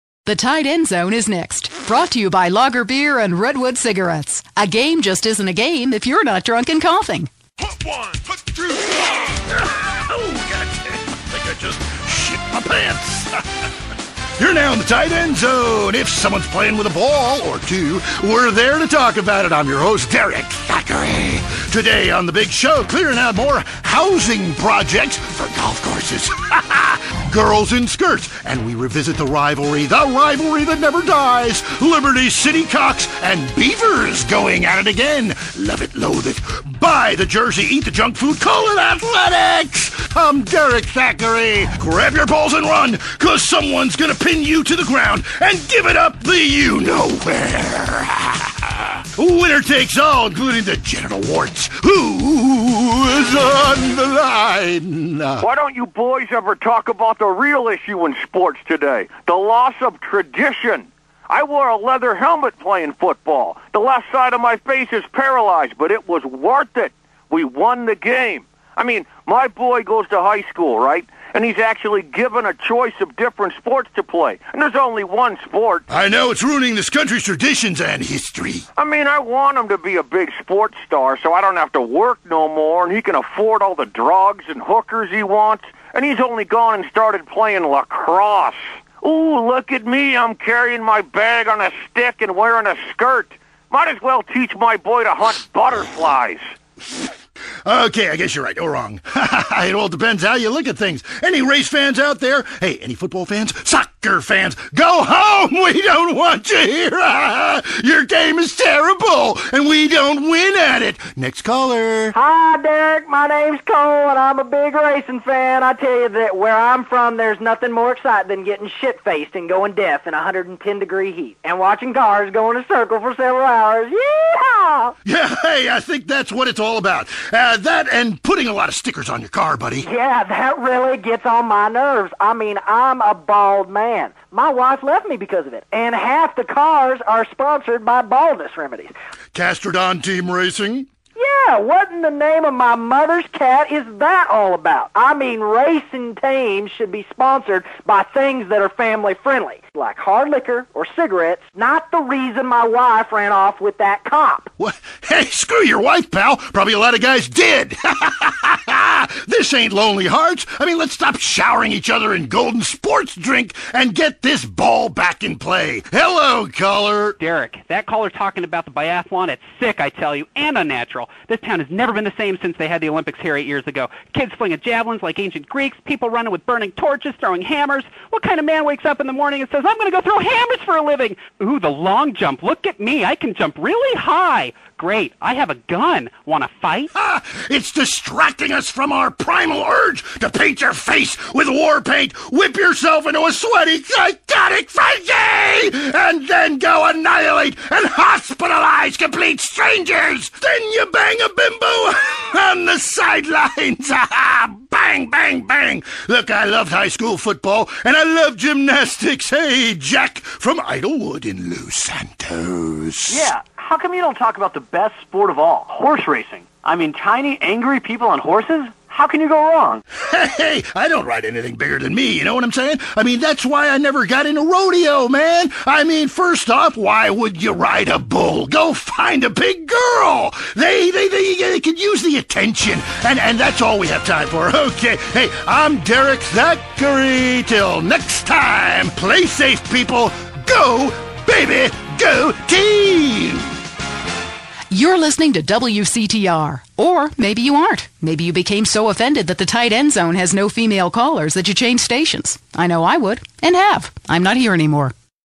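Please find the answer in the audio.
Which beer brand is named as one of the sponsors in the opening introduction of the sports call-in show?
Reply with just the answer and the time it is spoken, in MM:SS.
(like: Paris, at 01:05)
Logger Beer, at 00:02.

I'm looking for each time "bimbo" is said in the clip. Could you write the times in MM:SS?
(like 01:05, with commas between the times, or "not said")
03:21.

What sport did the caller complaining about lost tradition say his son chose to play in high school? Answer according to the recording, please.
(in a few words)
lacrosse.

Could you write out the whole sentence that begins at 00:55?
Why don't you boys ever talk about the real issue in sports today?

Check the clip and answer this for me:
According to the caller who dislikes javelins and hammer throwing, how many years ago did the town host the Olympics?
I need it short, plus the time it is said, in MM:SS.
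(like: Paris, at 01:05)
8, at 02:53.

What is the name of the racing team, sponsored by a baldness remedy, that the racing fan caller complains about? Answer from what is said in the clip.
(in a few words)
Castrodon Team Racing.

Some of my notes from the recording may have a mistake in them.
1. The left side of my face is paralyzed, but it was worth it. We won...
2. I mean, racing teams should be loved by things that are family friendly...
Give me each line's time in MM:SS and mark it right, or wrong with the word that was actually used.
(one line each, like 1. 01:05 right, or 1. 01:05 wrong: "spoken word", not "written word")
1. 01:03 right
2. 02:24 wrong: "sponsored", not "loved".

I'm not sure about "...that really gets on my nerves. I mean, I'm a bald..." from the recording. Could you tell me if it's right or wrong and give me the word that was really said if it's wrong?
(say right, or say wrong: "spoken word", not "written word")
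right.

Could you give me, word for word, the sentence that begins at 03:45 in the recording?
I mean, first off, why would you ride a bull?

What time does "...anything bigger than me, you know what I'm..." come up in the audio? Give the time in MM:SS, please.
03:41.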